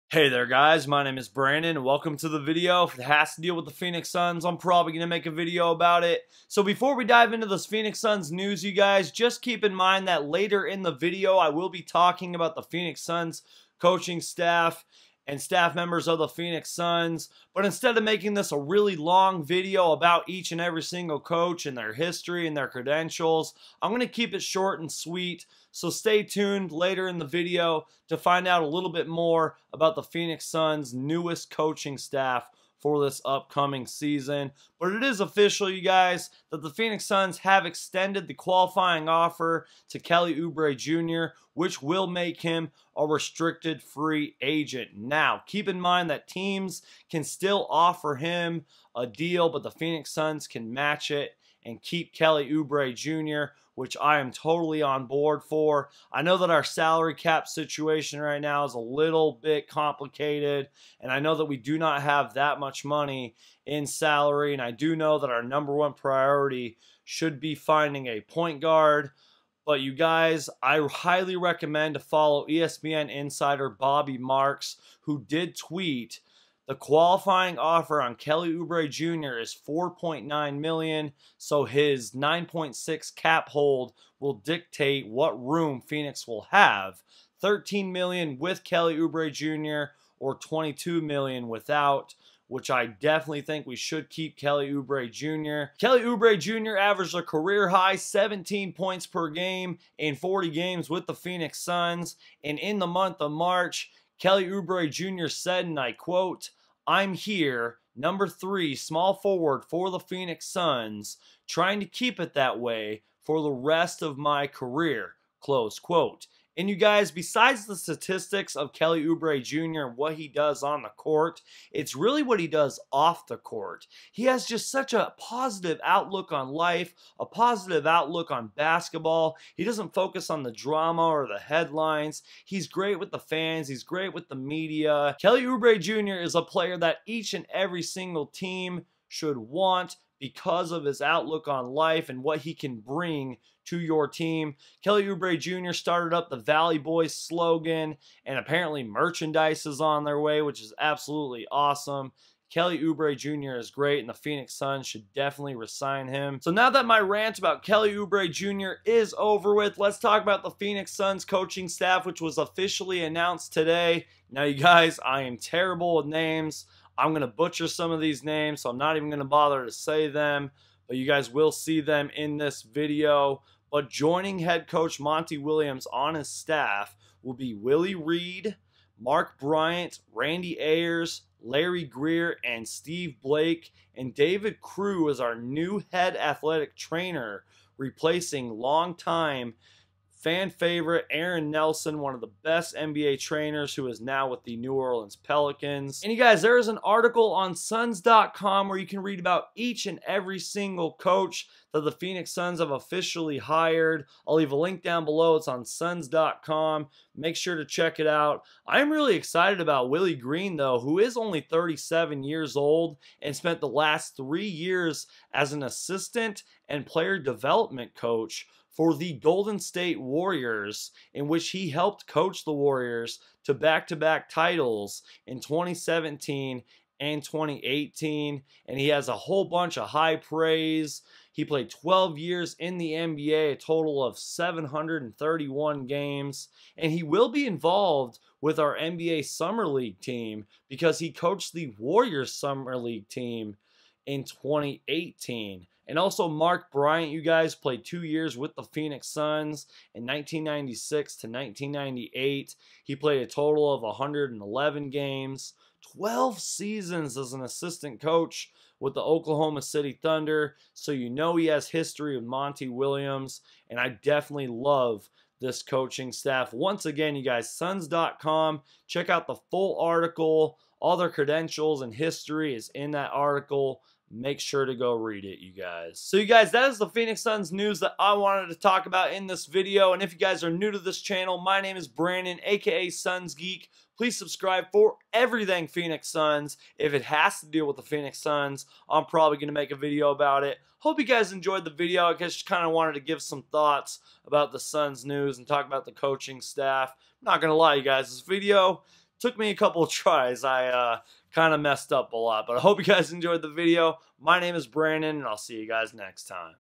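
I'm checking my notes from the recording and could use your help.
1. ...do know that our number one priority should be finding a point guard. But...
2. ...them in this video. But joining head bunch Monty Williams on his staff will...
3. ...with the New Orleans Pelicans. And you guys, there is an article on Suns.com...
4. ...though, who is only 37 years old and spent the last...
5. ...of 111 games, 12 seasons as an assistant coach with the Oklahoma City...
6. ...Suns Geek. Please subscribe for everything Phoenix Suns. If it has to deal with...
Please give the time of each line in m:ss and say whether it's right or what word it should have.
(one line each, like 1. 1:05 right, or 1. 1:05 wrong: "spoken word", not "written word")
1. 1:04 right
2. 2:51 wrong: "coach", not "bunch"
3. 3:14 right
4. 3:30 right
5. 4:13 right
6. 4:42 right.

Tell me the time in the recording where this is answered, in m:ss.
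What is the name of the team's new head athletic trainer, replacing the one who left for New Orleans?
3:04.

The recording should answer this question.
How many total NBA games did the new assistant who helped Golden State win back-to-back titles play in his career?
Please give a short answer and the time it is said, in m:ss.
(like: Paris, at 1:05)
731, at 3:54.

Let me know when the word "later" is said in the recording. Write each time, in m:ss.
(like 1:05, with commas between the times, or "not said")
0:10, 0:26.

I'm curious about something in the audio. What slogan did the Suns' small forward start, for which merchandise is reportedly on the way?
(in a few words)
Valley Boys.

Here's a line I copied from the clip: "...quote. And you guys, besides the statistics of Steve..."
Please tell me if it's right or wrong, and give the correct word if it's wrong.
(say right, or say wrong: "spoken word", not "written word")
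wrong: "Kelly", not "Steve".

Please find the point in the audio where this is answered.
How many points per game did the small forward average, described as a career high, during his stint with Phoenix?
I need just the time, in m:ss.
1:37.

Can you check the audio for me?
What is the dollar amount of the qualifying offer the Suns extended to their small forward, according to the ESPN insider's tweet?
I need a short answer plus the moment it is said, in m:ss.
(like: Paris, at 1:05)
4.9 million, at 1:19.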